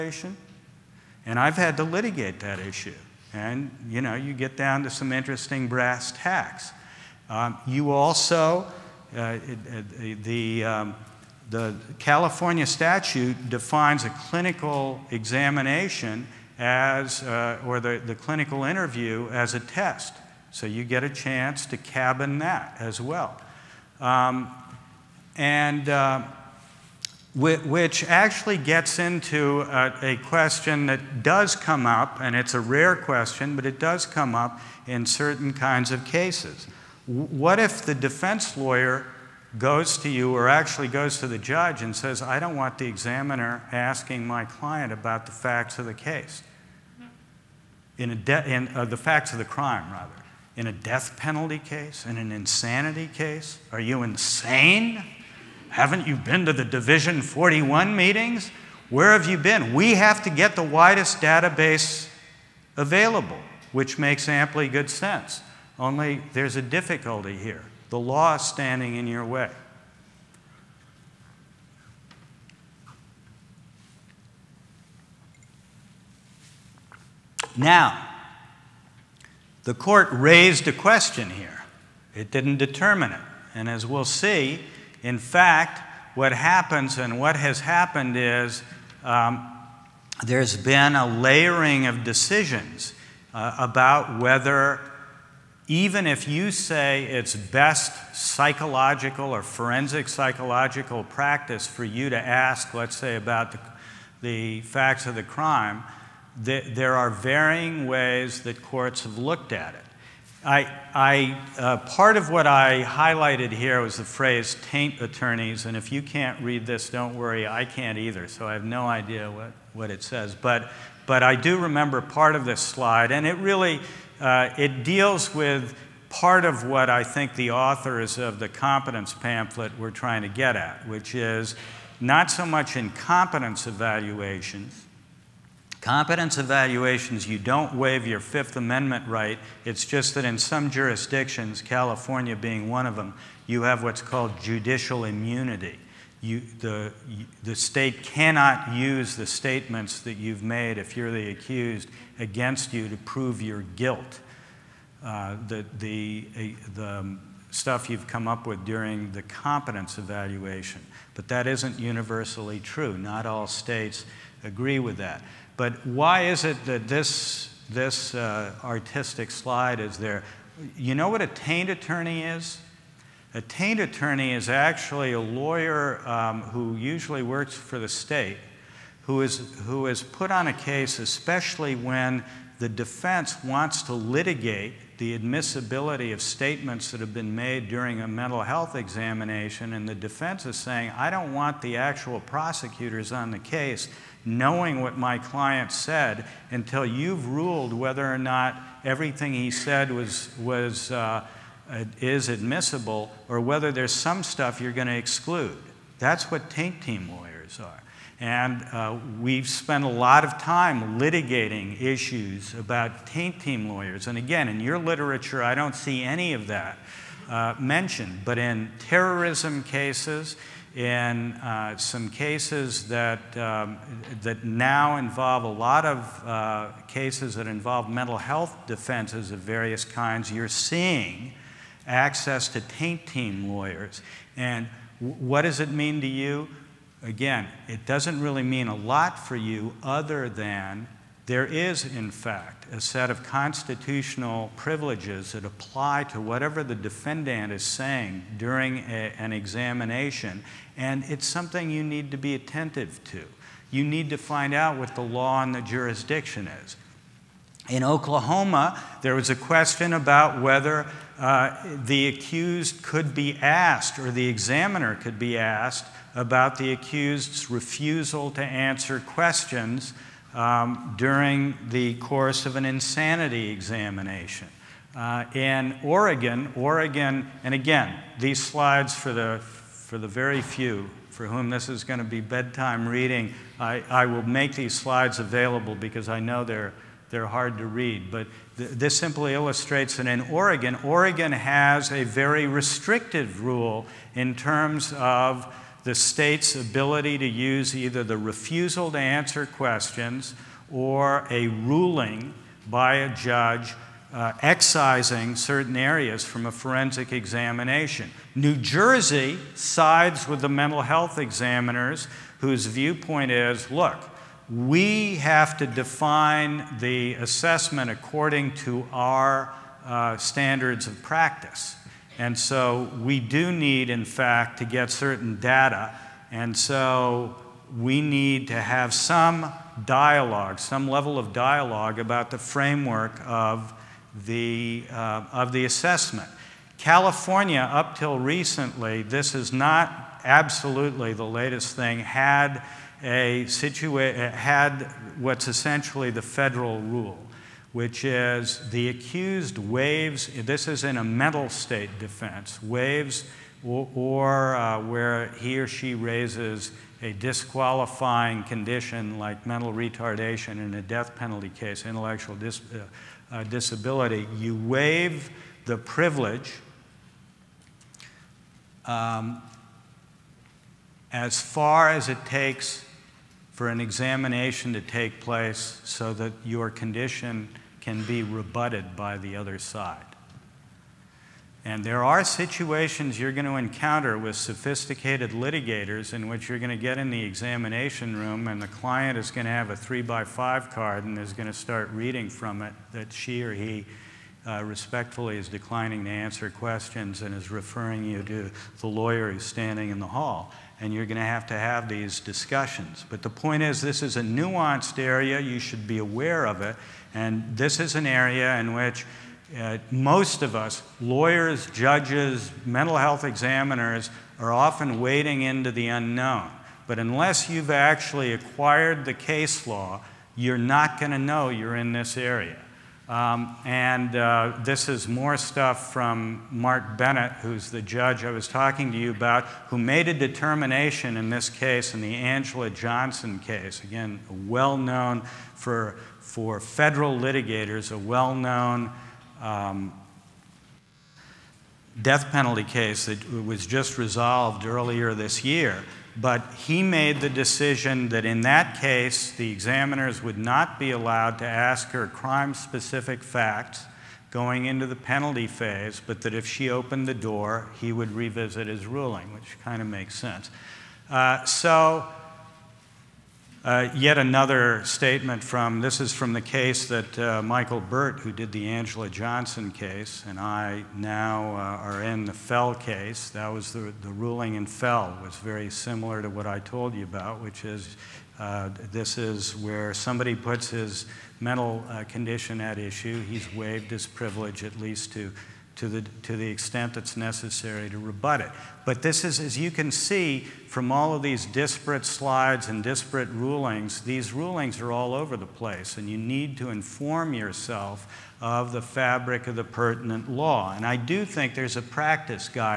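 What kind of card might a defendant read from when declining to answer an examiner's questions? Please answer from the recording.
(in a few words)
three by five card.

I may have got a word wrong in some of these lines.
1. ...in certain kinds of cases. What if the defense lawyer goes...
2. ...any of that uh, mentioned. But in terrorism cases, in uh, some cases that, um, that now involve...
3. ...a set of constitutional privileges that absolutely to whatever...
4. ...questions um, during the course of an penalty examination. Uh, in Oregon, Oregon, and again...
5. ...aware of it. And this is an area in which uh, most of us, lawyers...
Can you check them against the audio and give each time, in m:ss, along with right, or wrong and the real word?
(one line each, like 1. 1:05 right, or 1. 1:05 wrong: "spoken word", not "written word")
1. 0:34 right
2. 3:36 right
3. 4:02 wrong: "apply", not "absolutely"
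4. 4:28 wrong: "insanity", not "penalty"
5. 6:45 right.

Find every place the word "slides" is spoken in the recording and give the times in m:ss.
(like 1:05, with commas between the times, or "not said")
2:02, 2:49, 4:38, 4:44, 8:12.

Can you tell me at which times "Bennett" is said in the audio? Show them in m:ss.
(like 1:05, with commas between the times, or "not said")
7:06.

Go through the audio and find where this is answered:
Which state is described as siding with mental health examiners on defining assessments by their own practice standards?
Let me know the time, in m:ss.
5:08.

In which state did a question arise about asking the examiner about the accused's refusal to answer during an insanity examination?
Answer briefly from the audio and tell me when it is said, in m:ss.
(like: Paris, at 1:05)
Oklahoma, at 4:17.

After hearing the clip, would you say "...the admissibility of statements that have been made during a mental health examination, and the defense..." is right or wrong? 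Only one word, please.
right.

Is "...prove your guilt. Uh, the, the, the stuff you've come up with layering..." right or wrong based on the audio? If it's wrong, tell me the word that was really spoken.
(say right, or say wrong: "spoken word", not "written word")
wrong: "during", not "layering".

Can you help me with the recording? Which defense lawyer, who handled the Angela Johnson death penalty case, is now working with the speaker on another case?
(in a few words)
Michael Burt.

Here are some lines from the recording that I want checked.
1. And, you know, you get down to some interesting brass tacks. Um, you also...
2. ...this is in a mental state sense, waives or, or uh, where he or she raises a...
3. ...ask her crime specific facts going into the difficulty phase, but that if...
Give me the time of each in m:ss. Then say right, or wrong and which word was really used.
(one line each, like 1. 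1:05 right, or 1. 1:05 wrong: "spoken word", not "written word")
1. 0:03 right
2. 5:50 wrong: "defense", not "sense"
3. 7:31 wrong: "penalty", not "difficulty".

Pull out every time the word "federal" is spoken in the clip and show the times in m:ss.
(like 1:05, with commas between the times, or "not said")
5:46, 7:16.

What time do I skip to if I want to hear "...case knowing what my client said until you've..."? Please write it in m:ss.
3:13.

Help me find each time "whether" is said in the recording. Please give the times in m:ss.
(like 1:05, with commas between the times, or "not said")
1:34, 3:17, 3:23, 4:20.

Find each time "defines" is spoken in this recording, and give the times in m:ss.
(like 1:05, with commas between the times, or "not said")
0:13, 5:15.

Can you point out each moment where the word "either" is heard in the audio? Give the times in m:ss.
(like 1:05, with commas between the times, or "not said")
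1:57, 4:57.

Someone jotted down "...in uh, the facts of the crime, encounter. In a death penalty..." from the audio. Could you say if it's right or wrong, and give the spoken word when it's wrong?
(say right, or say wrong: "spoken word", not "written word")
wrong: "rather", not "encounter".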